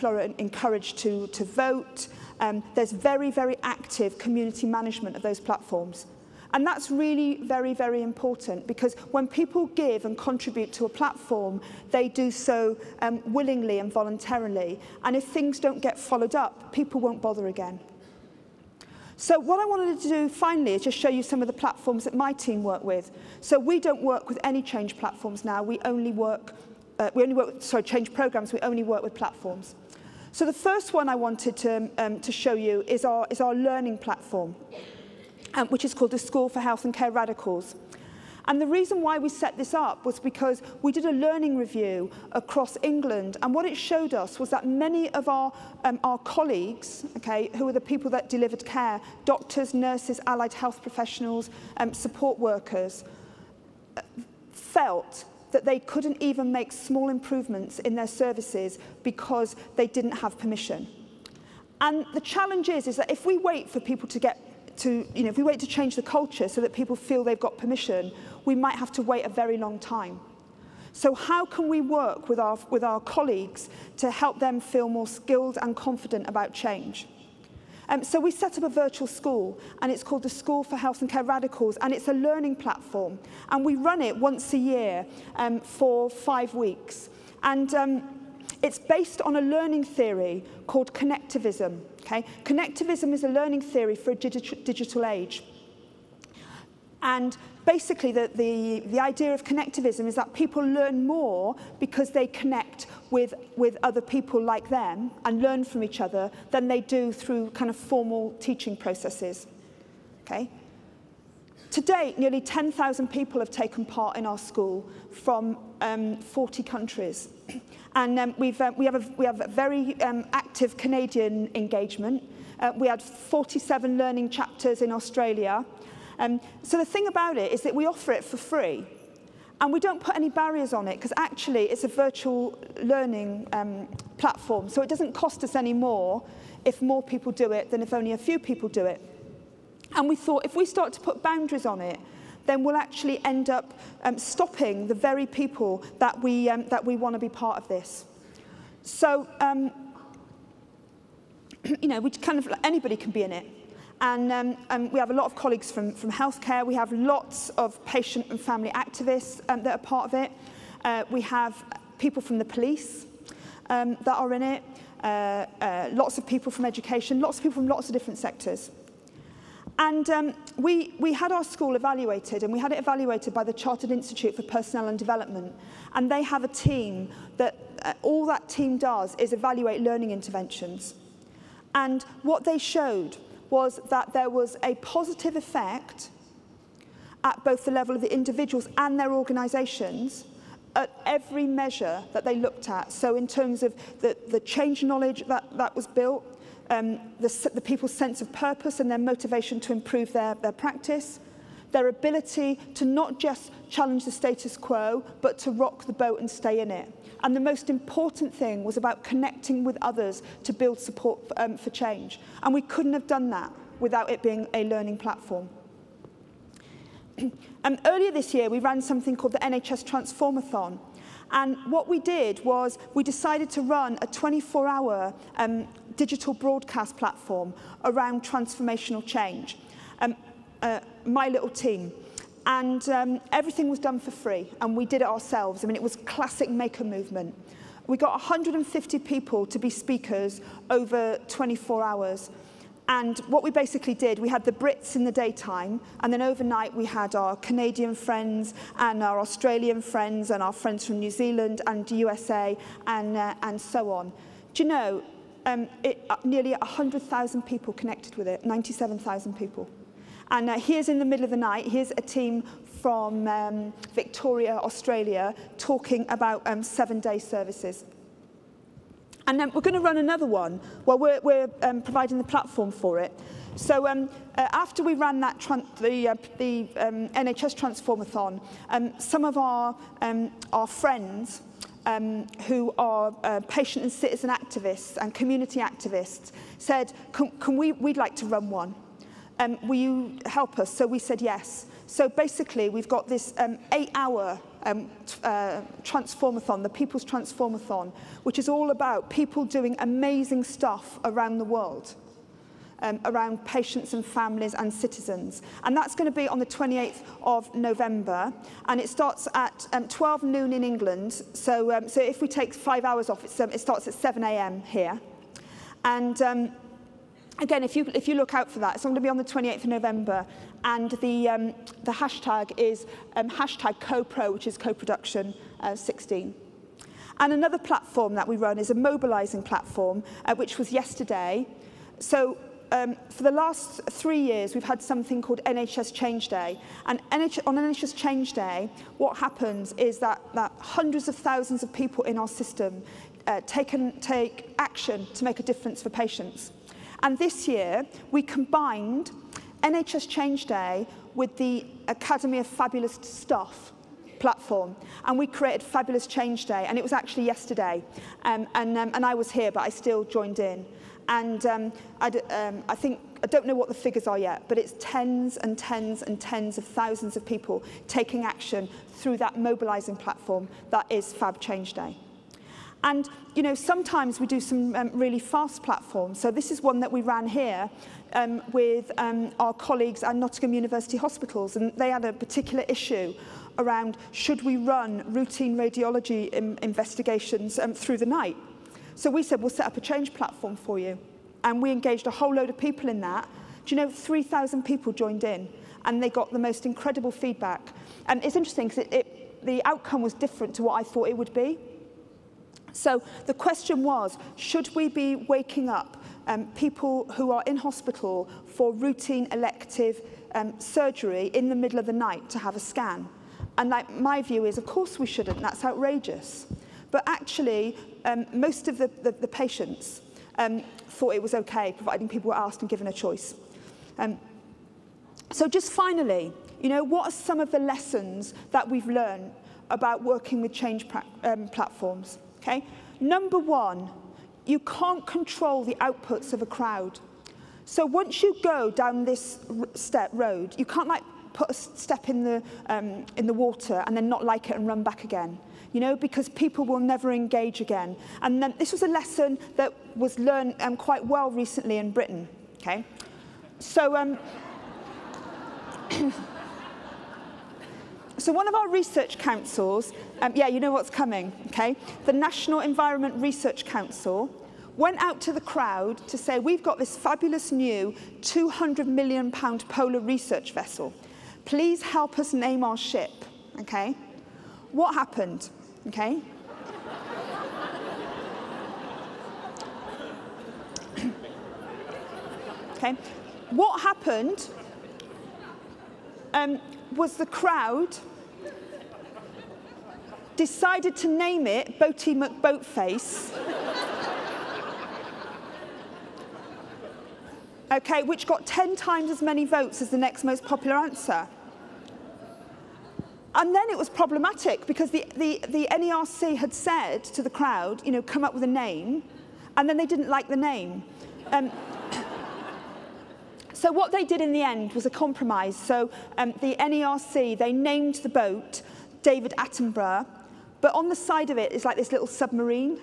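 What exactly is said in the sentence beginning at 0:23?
So we don't work with any change platforms now.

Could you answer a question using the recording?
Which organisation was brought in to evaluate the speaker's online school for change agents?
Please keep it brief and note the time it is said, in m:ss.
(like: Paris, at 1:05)
Chartered Institute for Personnel and Development, at 2:53.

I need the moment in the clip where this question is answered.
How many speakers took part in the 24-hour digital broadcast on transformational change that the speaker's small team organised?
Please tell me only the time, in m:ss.
3:58.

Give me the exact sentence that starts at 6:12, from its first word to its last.
And, you know, sometimes we do some um, really fast platforms.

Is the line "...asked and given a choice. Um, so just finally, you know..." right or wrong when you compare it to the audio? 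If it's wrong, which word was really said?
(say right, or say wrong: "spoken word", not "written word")
right.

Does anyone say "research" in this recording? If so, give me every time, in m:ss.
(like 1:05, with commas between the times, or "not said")
7:38, 7:43, 7:49.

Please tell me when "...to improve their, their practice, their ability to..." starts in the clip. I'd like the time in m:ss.
3:19.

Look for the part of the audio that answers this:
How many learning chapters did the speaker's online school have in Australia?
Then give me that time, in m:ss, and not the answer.
2:03.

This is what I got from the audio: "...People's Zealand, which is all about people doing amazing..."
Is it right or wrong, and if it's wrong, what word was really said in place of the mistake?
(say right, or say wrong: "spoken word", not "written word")
wrong: "Transformathon", not "Zealand".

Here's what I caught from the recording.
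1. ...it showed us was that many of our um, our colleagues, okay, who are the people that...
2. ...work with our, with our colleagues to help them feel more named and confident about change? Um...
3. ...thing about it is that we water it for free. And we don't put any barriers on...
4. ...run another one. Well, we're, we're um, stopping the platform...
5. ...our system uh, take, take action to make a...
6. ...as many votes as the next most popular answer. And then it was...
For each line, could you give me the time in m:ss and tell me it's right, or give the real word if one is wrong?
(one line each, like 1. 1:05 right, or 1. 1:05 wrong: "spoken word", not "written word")
1. 0:43 right
2. 1:11 wrong: "skilled", not "named"
3. 2:06 wrong: "offer", not "water"
4. 4:29 wrong: "providing", not "stopping"
5. 5:42 right
6. 8:19 right.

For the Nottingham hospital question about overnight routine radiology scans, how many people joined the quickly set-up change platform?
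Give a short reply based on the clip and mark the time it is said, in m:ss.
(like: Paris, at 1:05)
3,000, at 6:33.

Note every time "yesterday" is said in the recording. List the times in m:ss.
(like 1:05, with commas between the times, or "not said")
5:30, 5:57.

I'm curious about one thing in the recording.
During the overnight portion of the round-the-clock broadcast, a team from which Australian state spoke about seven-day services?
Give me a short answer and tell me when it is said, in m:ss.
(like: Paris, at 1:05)
Victoria, at 4:23.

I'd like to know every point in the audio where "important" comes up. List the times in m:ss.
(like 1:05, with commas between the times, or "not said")
0:08, 3:27.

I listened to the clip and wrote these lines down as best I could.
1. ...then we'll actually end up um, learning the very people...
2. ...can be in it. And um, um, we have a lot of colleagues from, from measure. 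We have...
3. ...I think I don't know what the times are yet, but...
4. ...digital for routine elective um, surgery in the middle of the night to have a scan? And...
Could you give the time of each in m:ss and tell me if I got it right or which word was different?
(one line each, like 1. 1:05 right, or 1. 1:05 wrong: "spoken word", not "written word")
1. 2:22 wrong: "stopping", not "learning"
2. 2:32 wrong: "healthcare", not "measure"
3. 6:02 wrong: "figures", not "times"
4. 6:47 wrong: "hospital", not "digital".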